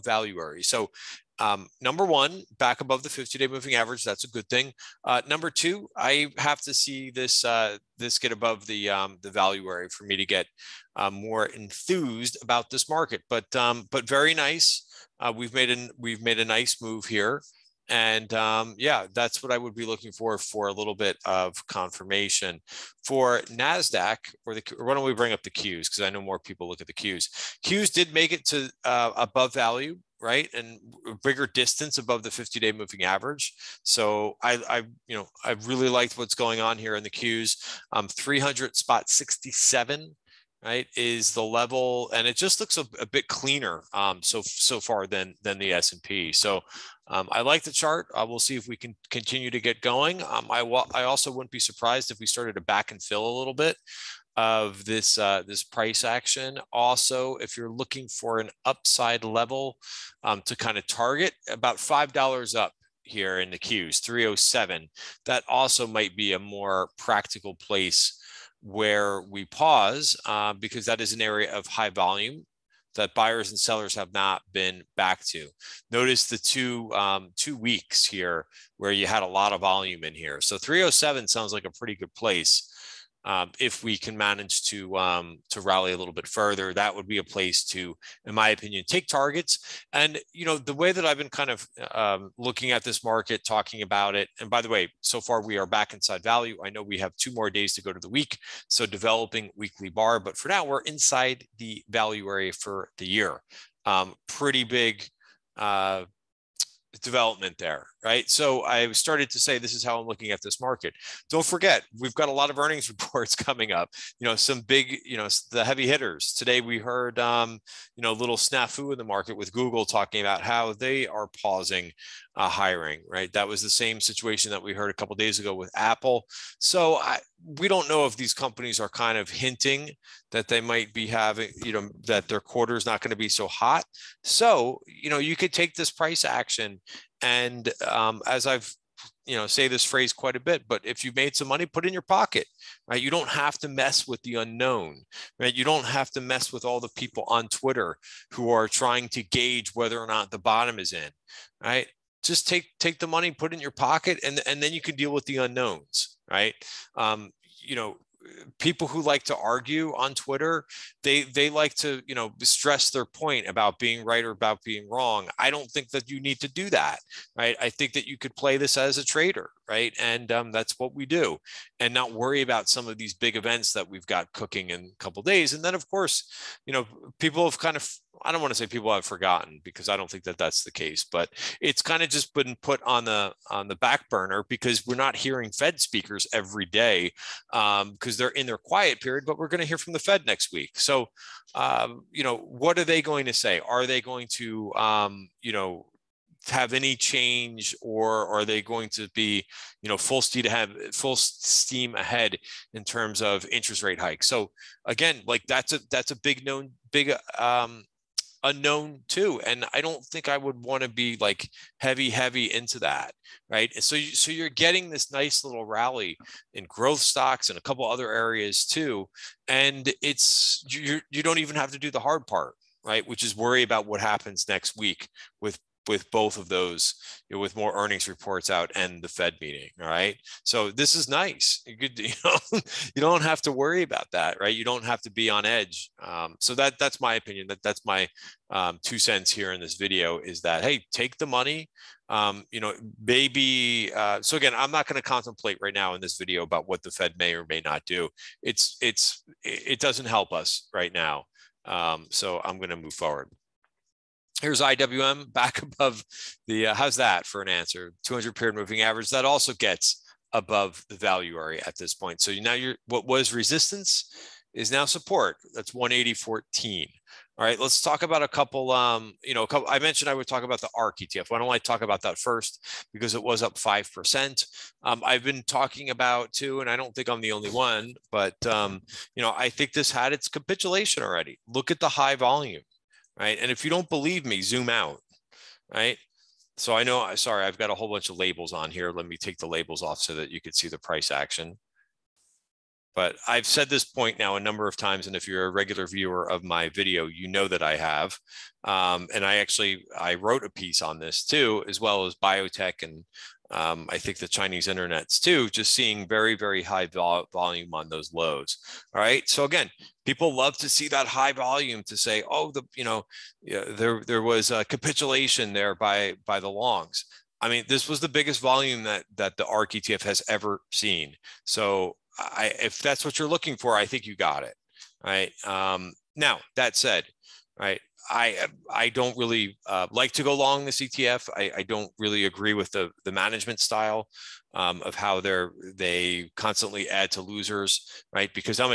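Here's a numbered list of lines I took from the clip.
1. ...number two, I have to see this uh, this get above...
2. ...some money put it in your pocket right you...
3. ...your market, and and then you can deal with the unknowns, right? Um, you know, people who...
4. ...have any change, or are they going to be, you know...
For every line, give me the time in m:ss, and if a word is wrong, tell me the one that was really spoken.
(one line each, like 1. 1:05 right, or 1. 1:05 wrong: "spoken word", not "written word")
1. 0:05 right
2. 2:21 right
3. 2:33 wrong: "pocket", not "market"
4. 3:16 right.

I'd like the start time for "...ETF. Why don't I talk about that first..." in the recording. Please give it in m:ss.
4:30.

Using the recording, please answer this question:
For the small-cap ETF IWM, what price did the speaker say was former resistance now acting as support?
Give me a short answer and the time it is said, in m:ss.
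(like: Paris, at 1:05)
180.14, at 4:25.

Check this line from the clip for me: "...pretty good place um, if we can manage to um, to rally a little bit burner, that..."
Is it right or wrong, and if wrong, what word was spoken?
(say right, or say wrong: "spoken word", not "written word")
wrong: "further", not "burner".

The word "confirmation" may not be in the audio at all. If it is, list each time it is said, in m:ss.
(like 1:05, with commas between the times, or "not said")
0:21.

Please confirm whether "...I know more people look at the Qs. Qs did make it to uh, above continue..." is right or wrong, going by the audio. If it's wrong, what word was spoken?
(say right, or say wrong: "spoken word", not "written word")
wrong: "value", not "continue".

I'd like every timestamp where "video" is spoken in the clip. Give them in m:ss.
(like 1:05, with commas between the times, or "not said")
3:59, 4:06, 4:56.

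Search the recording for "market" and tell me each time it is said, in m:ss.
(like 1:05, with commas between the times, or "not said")
0:12, 1:33, 1:50, 1:59.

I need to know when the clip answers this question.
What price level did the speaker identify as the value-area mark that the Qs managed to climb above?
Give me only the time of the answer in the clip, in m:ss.
0:38.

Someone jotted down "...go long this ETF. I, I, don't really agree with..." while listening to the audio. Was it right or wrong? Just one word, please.
right.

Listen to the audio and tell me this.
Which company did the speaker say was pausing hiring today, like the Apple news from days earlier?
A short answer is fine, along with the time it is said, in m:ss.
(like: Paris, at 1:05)
Google, at 1:59.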